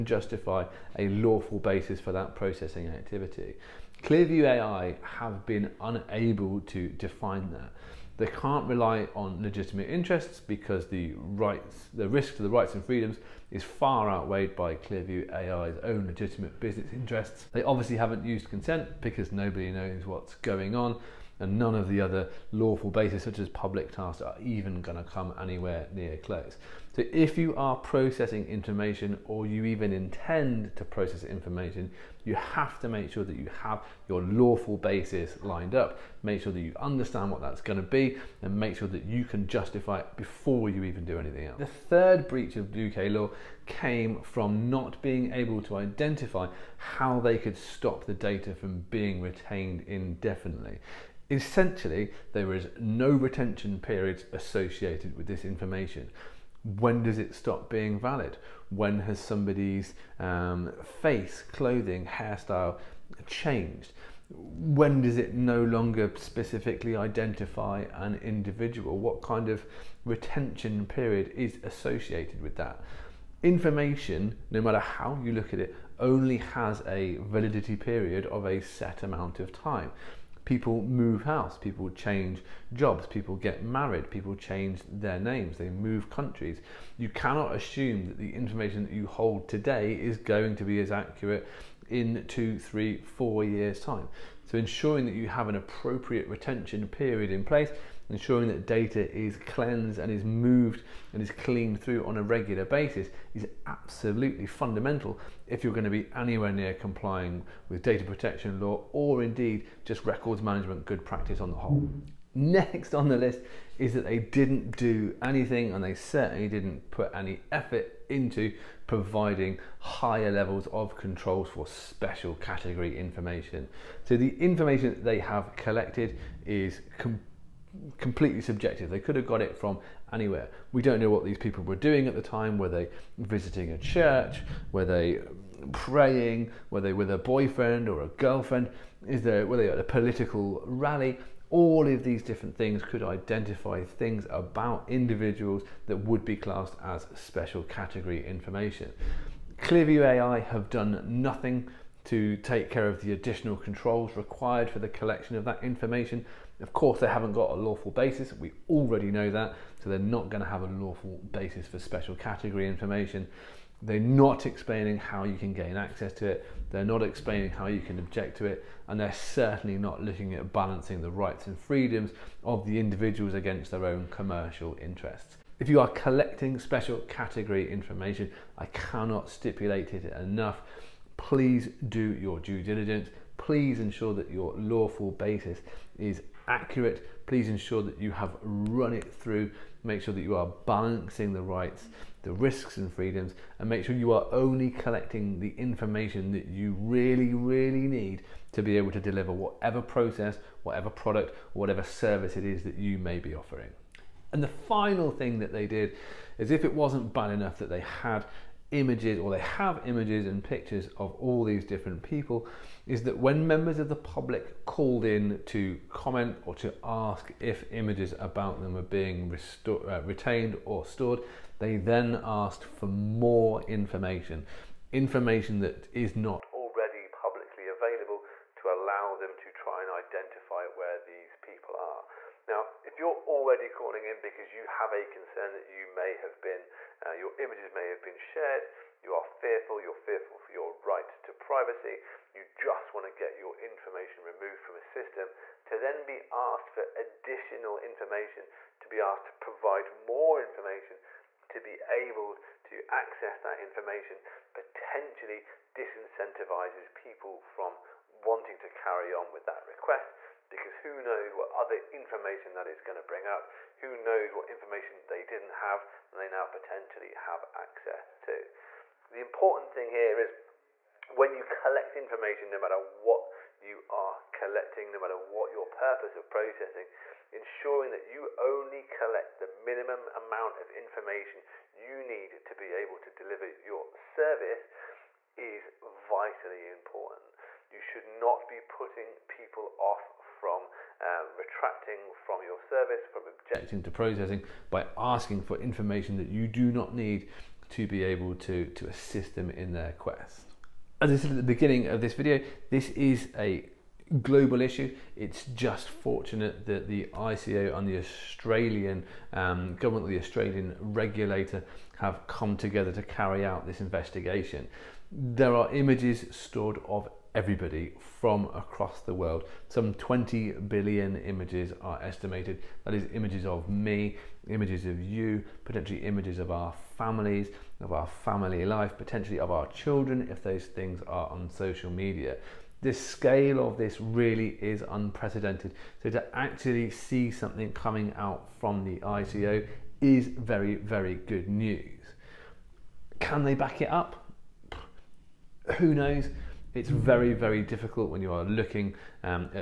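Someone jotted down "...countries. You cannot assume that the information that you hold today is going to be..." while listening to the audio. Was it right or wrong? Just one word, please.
right.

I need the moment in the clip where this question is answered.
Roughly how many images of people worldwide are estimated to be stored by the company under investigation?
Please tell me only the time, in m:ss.
5:19.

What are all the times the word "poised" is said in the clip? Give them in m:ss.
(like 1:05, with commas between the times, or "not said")
not said.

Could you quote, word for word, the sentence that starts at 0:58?
When has somebody's um, face, clothing, hairstyle changed?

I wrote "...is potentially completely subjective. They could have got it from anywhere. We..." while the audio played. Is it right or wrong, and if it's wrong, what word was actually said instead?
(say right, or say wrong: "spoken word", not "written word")
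wrong: "completely", not "potentially".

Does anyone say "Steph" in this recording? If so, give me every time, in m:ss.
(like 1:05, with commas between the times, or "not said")
not said.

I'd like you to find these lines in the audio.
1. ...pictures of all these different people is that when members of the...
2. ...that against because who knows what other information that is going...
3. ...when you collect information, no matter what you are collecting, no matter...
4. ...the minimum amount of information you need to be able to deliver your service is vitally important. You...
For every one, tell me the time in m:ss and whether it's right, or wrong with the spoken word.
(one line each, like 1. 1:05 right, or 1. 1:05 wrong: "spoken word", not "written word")
1. 3:30 right
2. 4:19 wrong: "request", not "against"
3. 4:31 right
4. 4:39 right.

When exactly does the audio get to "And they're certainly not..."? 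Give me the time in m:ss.
2:48.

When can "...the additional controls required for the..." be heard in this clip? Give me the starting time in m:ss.
2:33.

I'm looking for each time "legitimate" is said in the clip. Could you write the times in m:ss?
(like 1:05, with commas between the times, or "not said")
0:09, 0:16.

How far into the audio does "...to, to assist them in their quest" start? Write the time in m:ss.
4:58.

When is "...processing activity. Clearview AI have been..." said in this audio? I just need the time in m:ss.
0:02.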